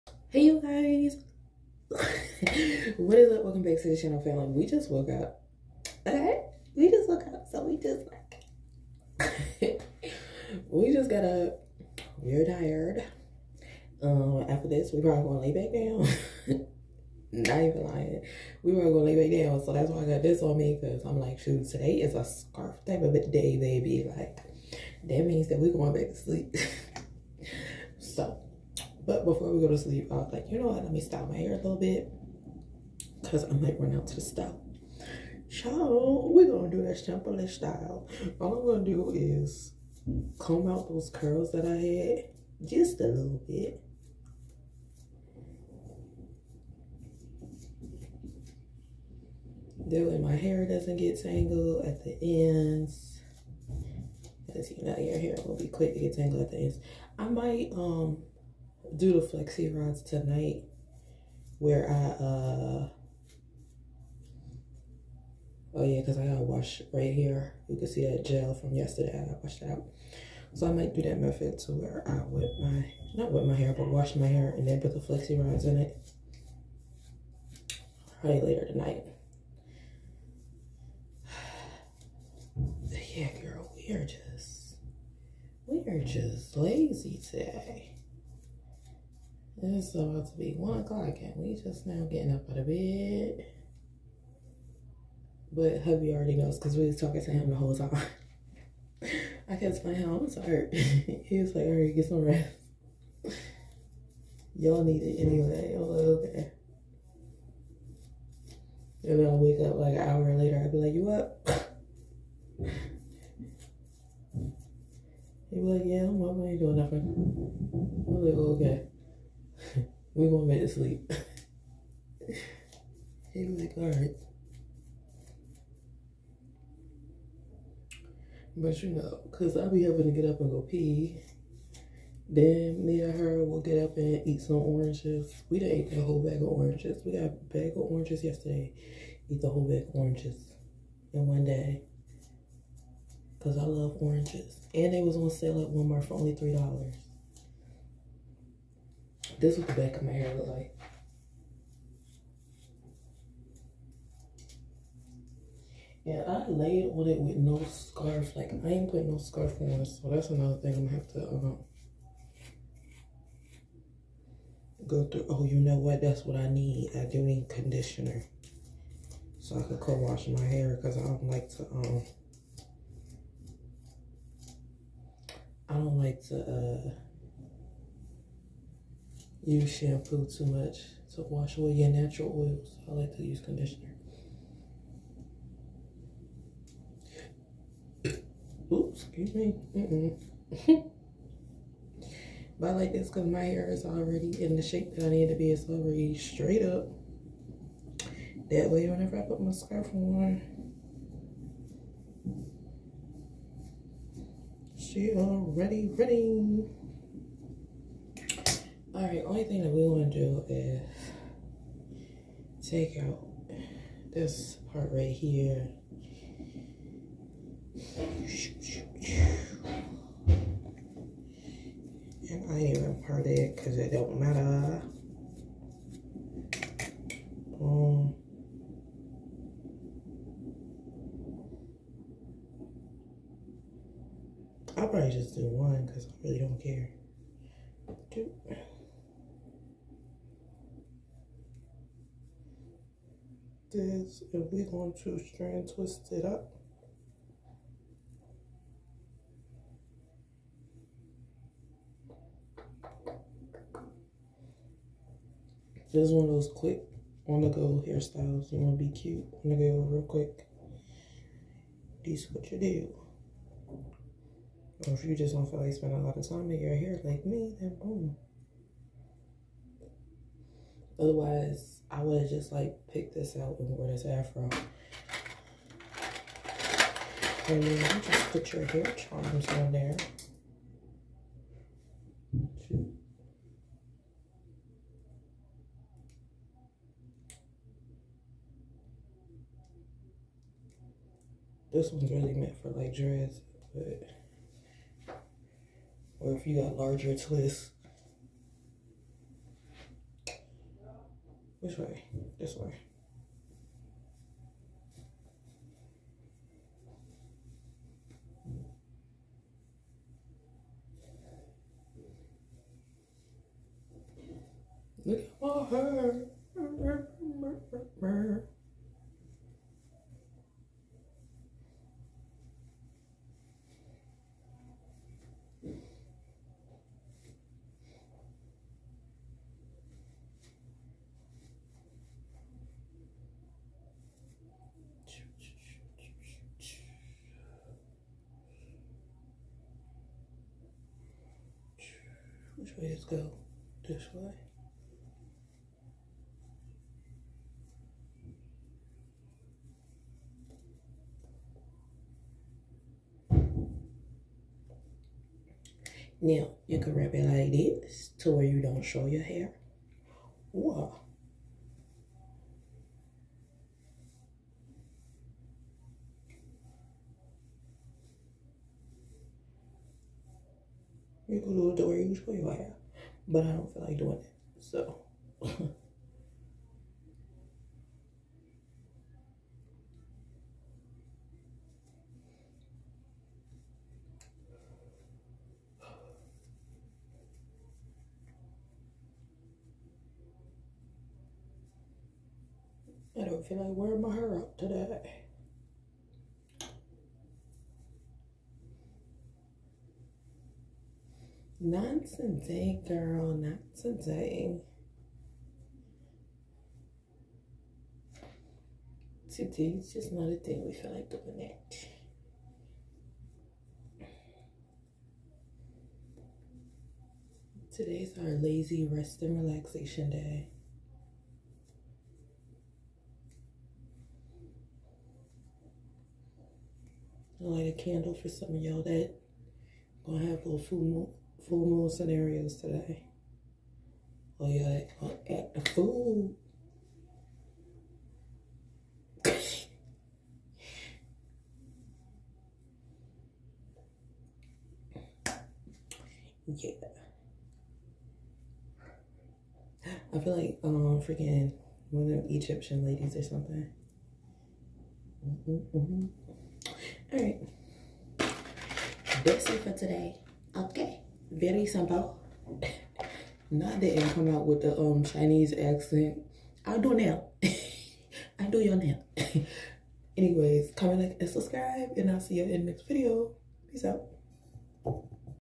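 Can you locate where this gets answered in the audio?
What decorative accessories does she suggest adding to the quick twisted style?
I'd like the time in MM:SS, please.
04:38.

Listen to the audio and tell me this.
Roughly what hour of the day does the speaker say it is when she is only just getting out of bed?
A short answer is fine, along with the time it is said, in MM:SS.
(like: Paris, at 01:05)
1 o'clock, at 01:30.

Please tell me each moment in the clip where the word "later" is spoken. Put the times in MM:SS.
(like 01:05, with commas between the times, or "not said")
01:18, 01:50.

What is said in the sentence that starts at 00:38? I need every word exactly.
All I'm gonna do is comb out those curls that I had just a little bit.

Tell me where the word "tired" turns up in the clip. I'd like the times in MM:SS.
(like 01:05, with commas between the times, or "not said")
00:12, 01:40.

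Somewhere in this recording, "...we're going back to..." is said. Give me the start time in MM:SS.
00:25.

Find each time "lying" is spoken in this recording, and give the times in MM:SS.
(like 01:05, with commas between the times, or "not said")
00:17.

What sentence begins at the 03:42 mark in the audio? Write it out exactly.
And I even part it because it don't matter.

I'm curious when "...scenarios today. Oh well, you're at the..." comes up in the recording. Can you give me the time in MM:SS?
07:11.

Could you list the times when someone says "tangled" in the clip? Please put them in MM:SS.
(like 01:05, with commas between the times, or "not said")
00:51, 00:56.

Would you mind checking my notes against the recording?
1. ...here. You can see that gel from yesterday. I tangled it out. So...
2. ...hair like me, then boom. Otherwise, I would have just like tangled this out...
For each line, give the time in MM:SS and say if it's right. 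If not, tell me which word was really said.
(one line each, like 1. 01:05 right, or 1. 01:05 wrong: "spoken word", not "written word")
1. 01:07 wrong: "washed", not "tangled"
2. 04:26 wrong: "picked", not "tangled".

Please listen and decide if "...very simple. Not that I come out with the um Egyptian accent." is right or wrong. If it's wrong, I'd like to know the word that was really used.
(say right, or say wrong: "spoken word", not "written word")
wrong: "Chinese", not "Egyptian".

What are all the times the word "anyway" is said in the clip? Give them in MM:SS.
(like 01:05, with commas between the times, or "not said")
01:45, 07:50.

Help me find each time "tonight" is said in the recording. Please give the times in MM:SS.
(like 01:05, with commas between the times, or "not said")
01:00, 01:18.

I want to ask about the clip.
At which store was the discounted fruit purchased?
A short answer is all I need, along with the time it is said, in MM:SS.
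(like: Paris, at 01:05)
Walmart, at 02:25.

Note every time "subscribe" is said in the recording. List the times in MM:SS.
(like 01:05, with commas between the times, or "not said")
07:51.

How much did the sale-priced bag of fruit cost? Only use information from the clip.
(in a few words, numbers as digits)
$3.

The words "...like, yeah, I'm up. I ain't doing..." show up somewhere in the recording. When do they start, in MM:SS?
01:55.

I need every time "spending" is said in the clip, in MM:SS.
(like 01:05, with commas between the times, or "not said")
04:25.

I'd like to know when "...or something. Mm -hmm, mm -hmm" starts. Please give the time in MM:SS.
07:33.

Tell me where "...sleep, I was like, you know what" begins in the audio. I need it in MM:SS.
00:29.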